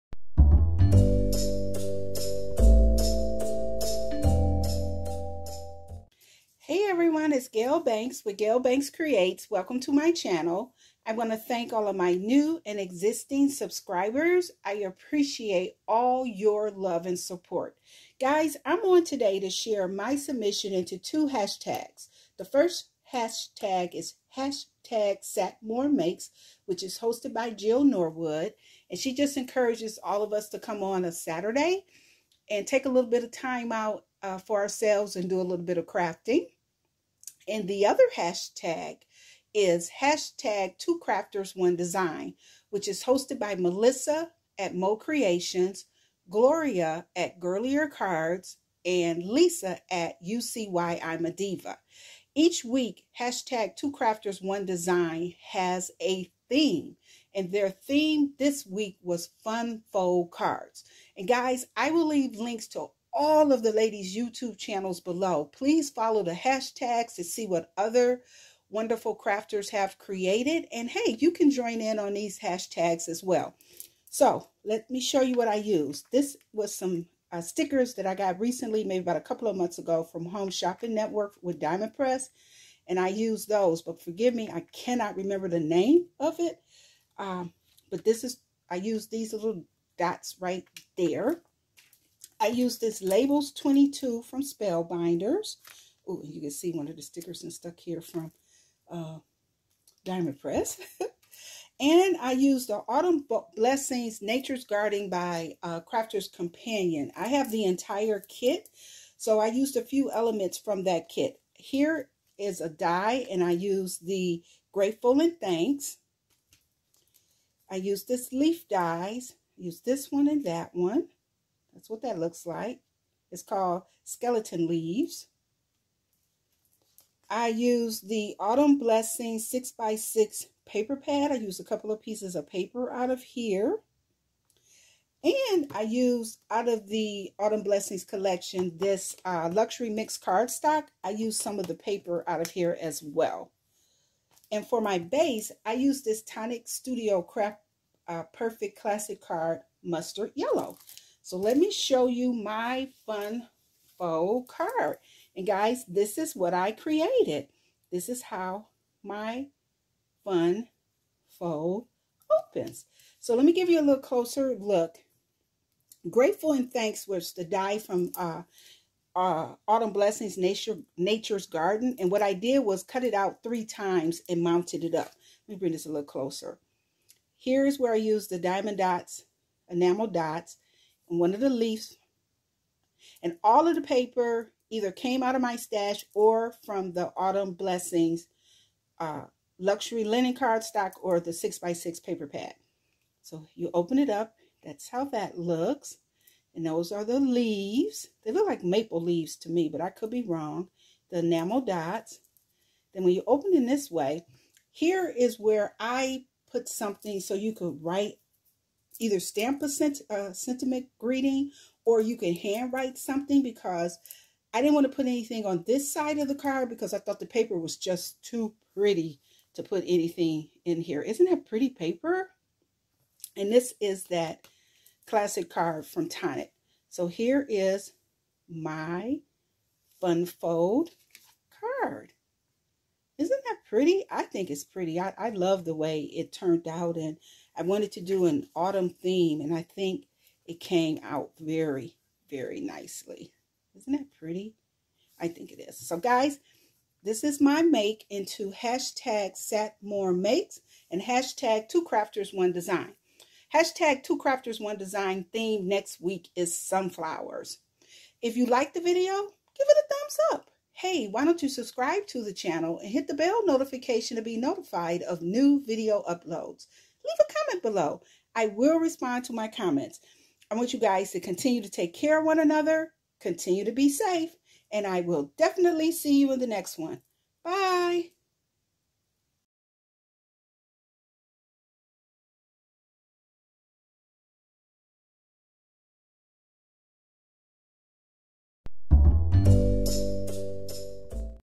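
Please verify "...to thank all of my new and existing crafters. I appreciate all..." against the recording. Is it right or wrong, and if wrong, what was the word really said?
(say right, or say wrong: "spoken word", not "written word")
wrong: "subscribers", not "crafters".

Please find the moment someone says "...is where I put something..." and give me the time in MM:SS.
03:25.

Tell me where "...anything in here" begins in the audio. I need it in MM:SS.
03:39.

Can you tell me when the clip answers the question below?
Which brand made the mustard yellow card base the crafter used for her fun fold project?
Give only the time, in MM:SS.
02:26.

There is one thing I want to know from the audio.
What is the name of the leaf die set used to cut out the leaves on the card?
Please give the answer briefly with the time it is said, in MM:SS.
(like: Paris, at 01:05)
Skeleton Leaves, at 02:04.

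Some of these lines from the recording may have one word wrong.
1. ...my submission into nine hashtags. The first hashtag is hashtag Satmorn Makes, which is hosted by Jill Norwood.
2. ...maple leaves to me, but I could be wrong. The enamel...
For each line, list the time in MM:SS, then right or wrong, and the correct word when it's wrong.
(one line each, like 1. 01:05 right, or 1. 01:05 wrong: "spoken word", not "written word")
1. 00:19 wrong: "two", not "nine"
2. 03:18 right.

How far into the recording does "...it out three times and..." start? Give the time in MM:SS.
02:53.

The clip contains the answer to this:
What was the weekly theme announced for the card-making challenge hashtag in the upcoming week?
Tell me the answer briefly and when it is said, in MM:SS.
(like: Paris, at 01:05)
Sunflowers, at 04:16.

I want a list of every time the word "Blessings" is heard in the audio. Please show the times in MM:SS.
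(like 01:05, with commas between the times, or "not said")
01:43, 02:08, 02:17, 02:49, 03:07.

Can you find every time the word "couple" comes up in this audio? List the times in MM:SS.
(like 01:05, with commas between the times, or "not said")
01:19, 02:11.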